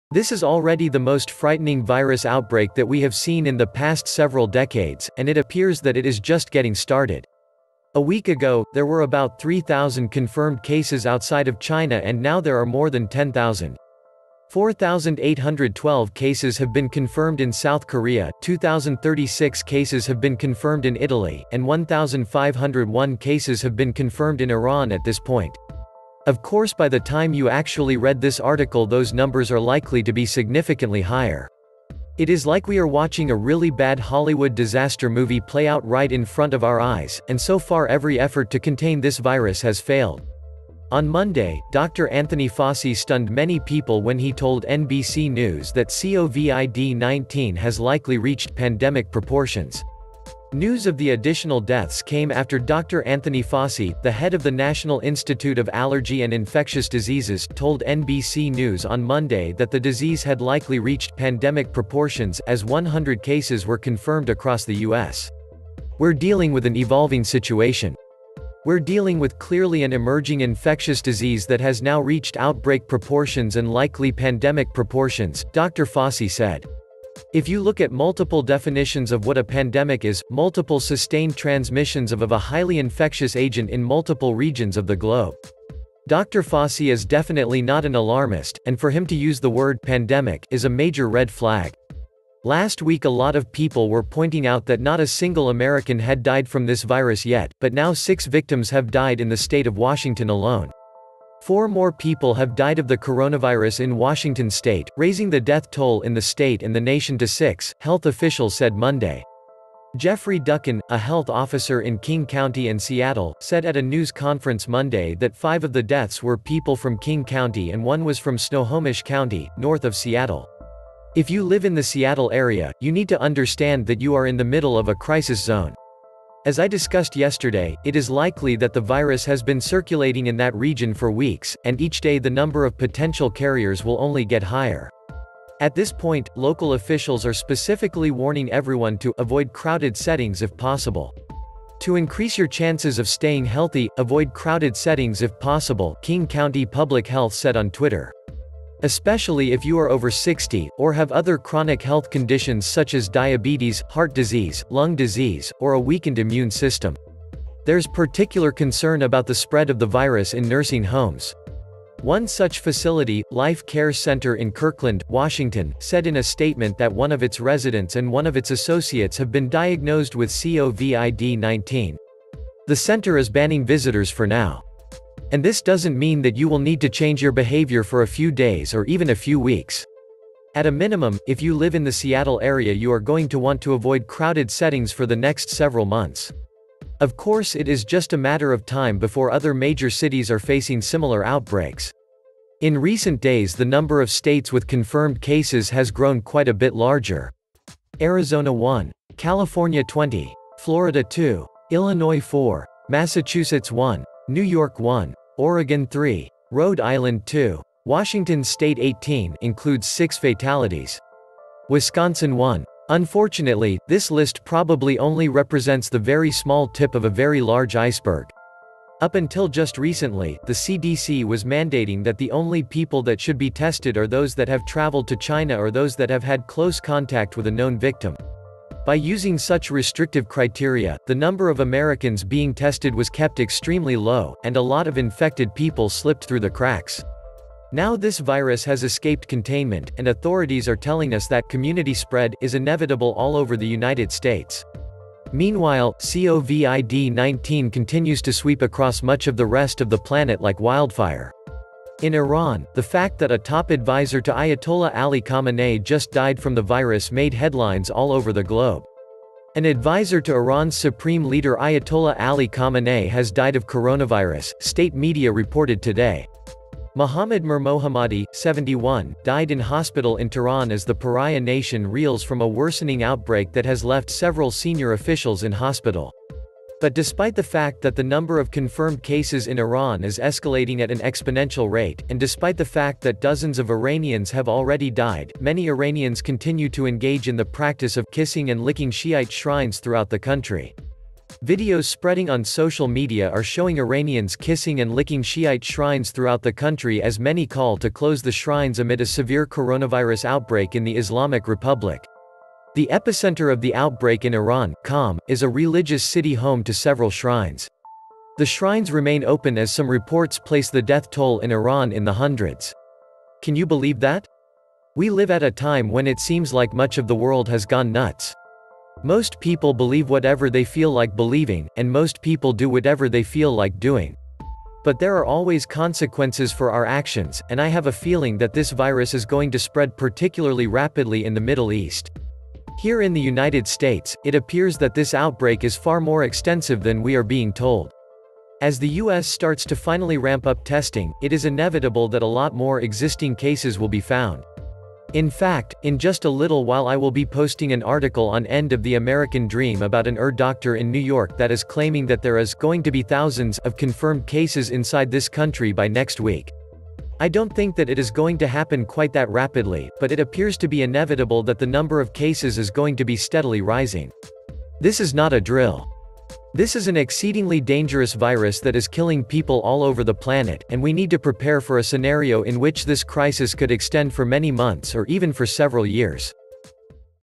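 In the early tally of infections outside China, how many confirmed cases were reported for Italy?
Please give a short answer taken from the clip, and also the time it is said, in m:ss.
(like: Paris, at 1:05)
2,036, at 0:18.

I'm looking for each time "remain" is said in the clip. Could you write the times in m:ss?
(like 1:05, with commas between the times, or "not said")
5:08.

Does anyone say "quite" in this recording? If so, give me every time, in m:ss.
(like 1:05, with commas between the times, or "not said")
3:16, 5:58.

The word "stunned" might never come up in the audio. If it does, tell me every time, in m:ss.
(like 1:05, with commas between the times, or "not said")
0:42.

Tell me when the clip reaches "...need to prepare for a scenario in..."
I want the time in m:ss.
6:10.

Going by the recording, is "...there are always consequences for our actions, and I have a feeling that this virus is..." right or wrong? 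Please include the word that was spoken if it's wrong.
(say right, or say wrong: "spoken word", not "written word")
right.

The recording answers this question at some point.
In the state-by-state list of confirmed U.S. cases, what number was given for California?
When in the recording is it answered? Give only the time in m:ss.
3:19.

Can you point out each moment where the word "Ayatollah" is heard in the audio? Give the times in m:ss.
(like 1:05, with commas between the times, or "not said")
4:14, 4:21.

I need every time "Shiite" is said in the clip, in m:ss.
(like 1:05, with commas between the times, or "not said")
4:48, 4:55.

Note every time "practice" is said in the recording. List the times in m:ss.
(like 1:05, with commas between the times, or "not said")
4:47.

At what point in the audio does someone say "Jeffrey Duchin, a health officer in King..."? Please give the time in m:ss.
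1:49.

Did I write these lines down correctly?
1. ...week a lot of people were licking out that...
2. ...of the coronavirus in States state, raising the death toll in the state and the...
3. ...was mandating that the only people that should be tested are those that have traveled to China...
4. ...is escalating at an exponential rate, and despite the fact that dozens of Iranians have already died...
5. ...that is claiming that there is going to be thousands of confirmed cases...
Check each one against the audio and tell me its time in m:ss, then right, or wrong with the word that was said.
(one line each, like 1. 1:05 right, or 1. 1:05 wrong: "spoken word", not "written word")
1. 1:32 wrong: "pointing", not "licking"
2. 1:42 wrong: "Washington", not "States"
3. 3:41 right
4. 4:40 right
5. 5:51 right.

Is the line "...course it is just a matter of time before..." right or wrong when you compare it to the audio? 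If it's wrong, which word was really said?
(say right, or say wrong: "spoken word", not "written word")
right.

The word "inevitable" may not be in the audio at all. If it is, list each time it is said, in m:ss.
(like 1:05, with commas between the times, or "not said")
4:02, 5:41, 6:00.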